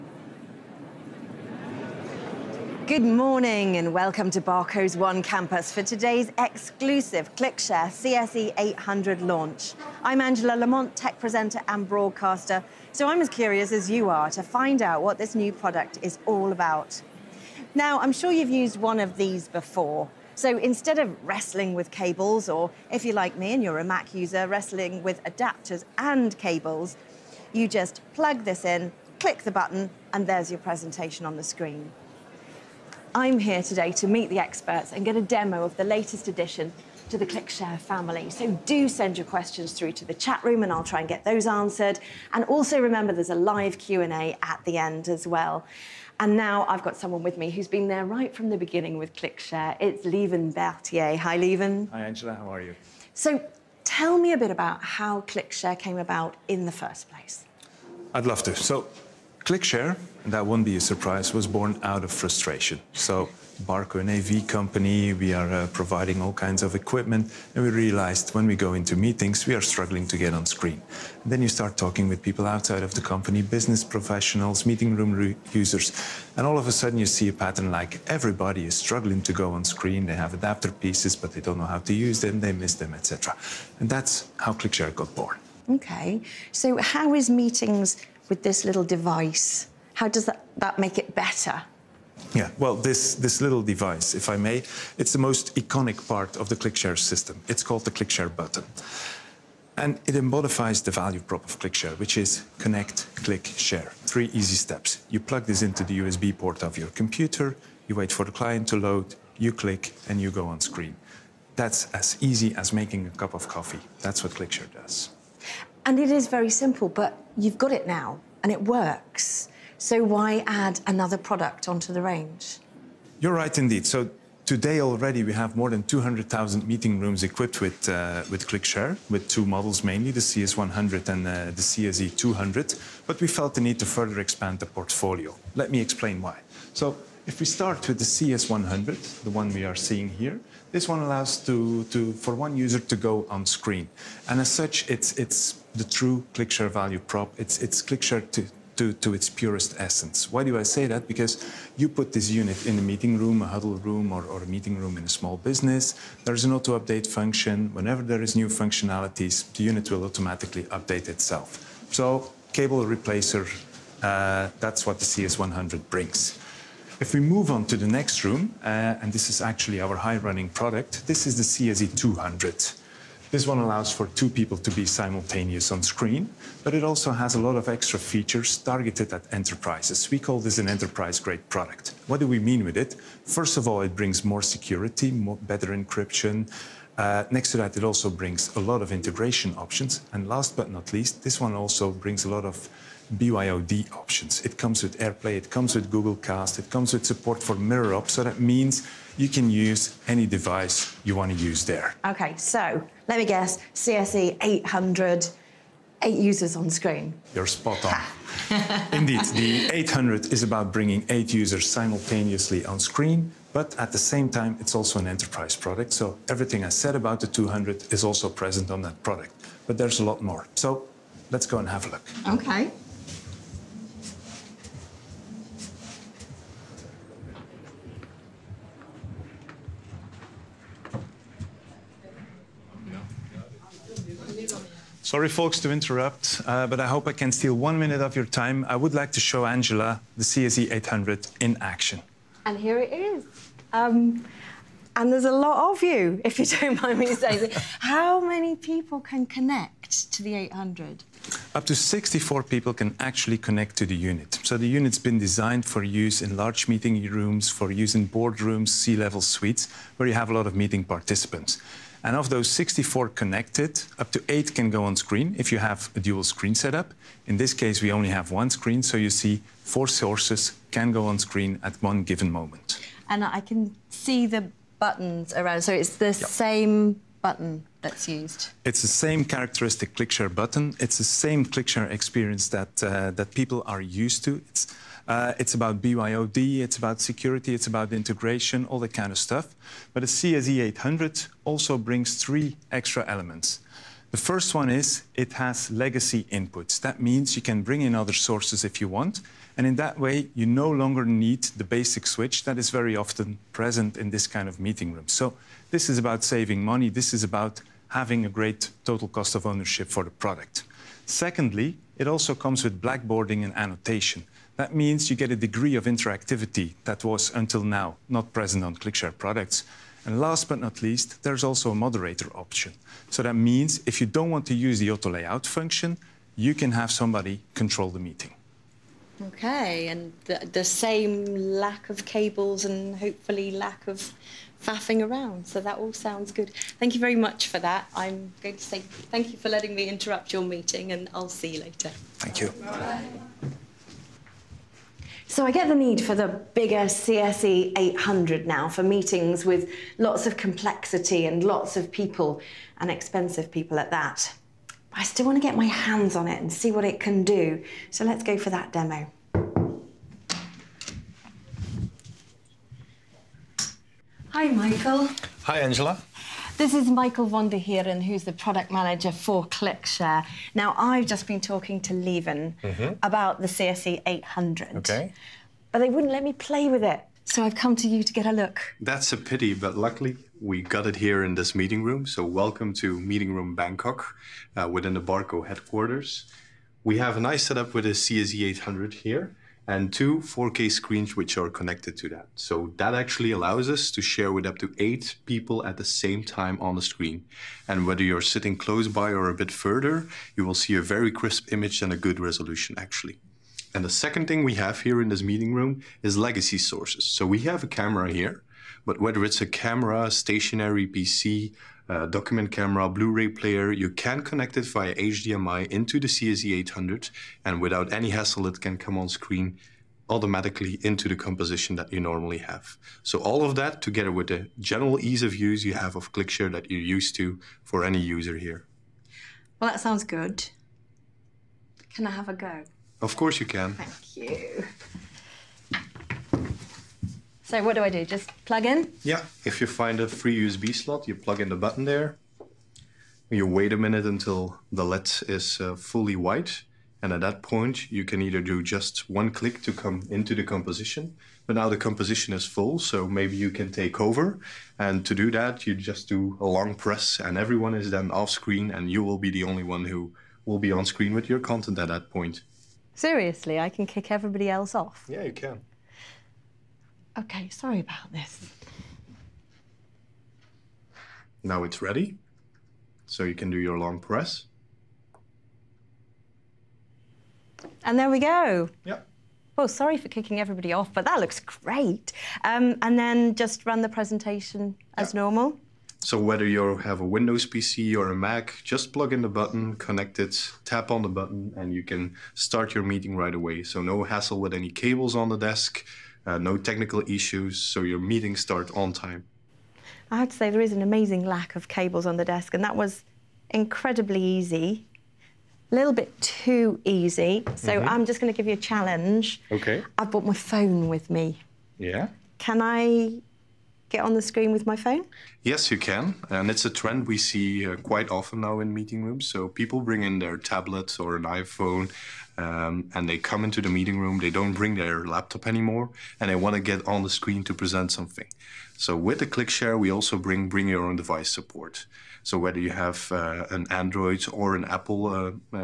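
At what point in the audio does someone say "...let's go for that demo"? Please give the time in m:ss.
5:58.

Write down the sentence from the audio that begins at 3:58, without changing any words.
I would like to show Angela the CSE 800 in action.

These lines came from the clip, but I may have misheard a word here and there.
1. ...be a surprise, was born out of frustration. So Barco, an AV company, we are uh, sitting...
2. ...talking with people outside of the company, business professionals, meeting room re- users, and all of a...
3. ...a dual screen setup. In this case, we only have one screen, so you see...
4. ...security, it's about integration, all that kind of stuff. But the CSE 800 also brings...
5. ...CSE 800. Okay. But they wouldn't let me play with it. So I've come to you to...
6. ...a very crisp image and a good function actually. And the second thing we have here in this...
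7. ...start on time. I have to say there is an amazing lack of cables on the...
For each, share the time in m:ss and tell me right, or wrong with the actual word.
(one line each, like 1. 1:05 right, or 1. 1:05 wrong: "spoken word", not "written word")
1. 1:00 wrong: "providing", not "sitting"
2. 1:11 right
3. 4:25 right
4. 4:46 right
5. 6:13 right
6. 6:40 wrong: "resolution", not "function"
7. 8:18 right.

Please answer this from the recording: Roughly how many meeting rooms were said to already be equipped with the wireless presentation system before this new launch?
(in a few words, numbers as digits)
200,000.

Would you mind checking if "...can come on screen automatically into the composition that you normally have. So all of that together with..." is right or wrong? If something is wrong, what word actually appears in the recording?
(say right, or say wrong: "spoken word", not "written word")
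right.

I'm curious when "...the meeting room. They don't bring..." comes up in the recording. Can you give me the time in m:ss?
8:43.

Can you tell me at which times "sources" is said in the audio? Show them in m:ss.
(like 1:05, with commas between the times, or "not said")
4:29, 4:58, 6:46.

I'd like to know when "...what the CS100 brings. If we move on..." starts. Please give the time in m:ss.
2:44.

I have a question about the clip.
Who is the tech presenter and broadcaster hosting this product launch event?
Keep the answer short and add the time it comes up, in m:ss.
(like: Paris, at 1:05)
Angela Lamont, at 0:10.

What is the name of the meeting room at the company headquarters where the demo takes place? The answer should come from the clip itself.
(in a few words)
Bangkok.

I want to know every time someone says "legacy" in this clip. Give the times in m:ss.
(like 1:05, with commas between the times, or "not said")
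4:55, 6:46.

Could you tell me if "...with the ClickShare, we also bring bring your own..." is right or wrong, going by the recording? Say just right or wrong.
right.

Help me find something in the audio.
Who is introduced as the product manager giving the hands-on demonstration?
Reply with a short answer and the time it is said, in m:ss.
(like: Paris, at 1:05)
Michael von der Heeren, at 6:06.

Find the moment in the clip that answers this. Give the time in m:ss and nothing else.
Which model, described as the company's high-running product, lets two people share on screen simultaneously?
2:51.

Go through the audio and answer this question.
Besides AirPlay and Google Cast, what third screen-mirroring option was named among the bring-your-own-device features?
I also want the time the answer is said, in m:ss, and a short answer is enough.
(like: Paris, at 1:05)
MirrorOp, at 3:17.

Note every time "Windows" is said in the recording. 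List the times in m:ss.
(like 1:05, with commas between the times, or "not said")
8:07.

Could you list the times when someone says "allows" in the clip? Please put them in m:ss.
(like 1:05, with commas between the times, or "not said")
2:20, 2:53, 6:33.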